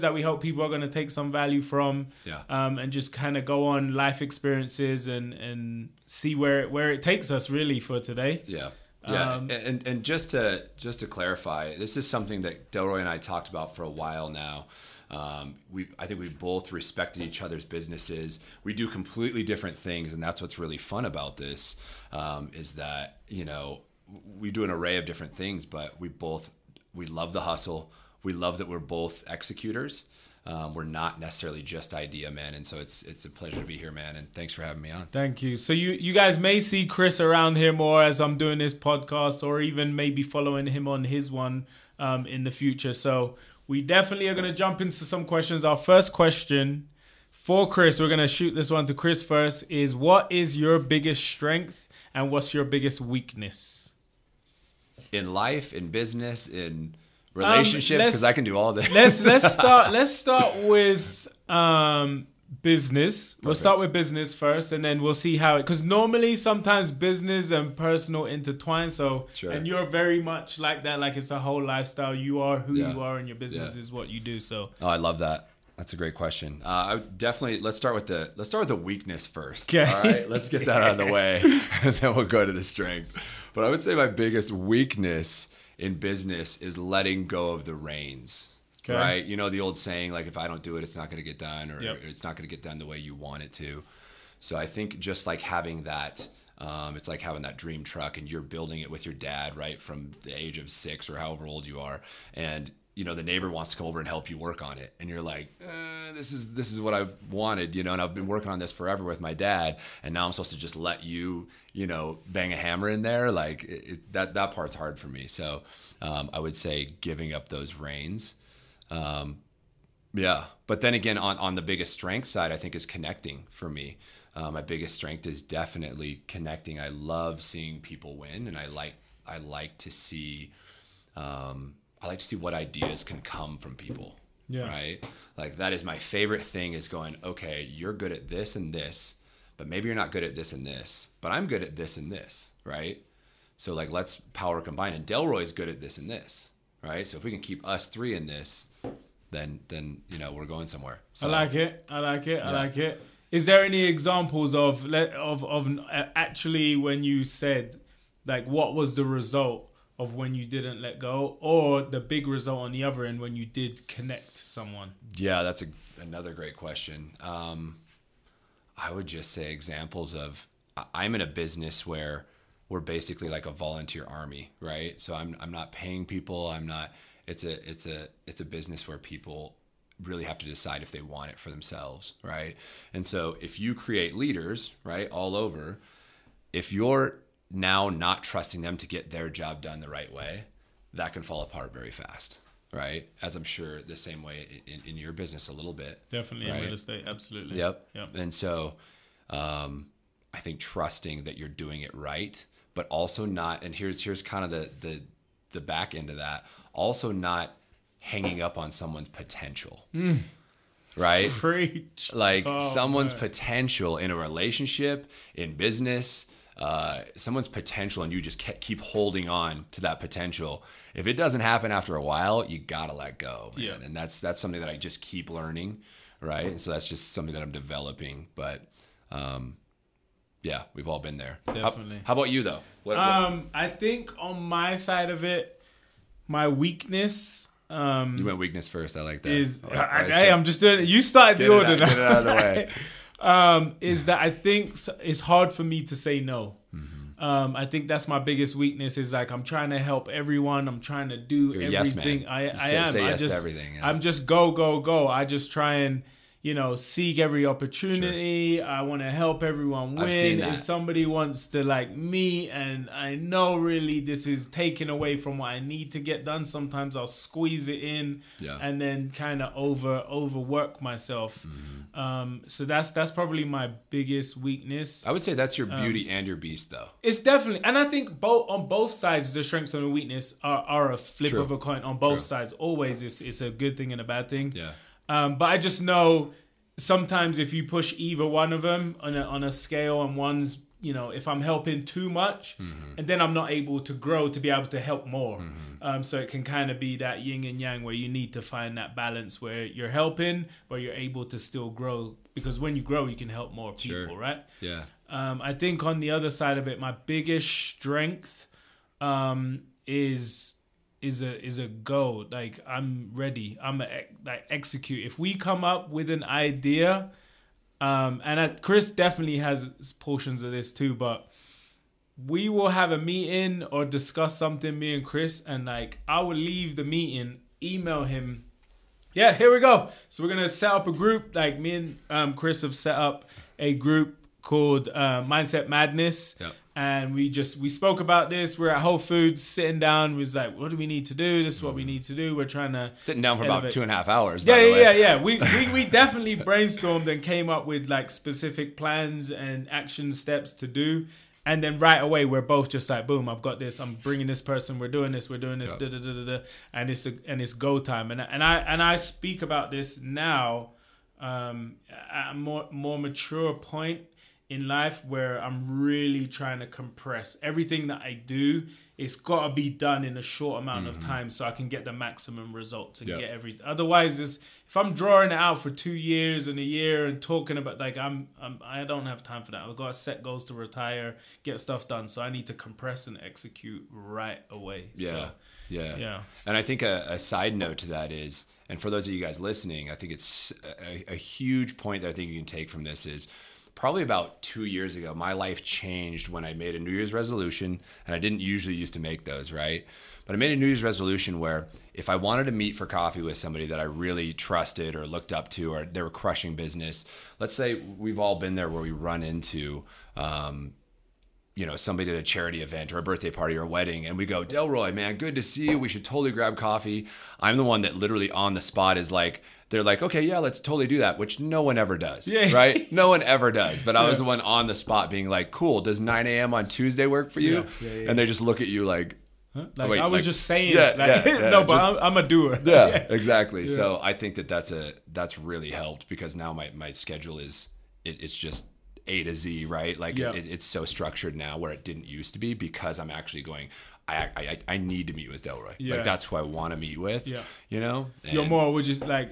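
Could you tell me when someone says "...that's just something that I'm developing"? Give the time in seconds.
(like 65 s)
226 s.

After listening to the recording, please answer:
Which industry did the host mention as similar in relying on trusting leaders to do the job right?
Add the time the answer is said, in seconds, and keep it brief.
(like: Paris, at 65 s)
real estate, at 196 s.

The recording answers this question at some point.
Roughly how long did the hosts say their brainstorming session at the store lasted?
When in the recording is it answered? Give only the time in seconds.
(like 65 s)
343 s.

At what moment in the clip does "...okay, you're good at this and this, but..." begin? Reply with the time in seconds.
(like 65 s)
137 s.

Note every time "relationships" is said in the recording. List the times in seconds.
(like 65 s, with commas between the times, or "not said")
57 s, 214 s.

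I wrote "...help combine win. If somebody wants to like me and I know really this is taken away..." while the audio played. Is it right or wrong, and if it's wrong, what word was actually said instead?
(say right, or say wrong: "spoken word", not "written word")
wrong: "everyone", not "combine".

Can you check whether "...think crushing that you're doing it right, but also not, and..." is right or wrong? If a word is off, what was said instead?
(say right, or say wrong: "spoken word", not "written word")
wrong: "trusting", not "crushing".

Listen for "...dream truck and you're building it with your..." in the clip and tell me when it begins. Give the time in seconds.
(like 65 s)
97 s.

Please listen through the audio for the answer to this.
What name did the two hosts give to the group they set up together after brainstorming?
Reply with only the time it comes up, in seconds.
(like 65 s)
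335 s.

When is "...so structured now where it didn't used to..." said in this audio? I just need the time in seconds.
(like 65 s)
440 s.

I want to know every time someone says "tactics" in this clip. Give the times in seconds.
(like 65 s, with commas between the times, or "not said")
not said.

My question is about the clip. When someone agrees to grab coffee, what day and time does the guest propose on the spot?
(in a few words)
9 a.m. Tuesday.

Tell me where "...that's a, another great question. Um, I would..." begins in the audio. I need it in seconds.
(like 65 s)
165 s.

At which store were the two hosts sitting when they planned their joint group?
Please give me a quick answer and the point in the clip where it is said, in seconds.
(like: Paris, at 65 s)
Whole Foods, at 338 s.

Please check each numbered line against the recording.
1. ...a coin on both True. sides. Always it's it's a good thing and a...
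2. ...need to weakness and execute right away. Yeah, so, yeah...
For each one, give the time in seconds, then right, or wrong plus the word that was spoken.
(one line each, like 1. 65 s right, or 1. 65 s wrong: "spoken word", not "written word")
1. 281 s right
2. 382 s wrong: "compress", not "weakness".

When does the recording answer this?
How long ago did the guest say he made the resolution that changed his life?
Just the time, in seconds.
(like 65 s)
394 s.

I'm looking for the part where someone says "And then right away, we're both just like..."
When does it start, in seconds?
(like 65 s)
351 s.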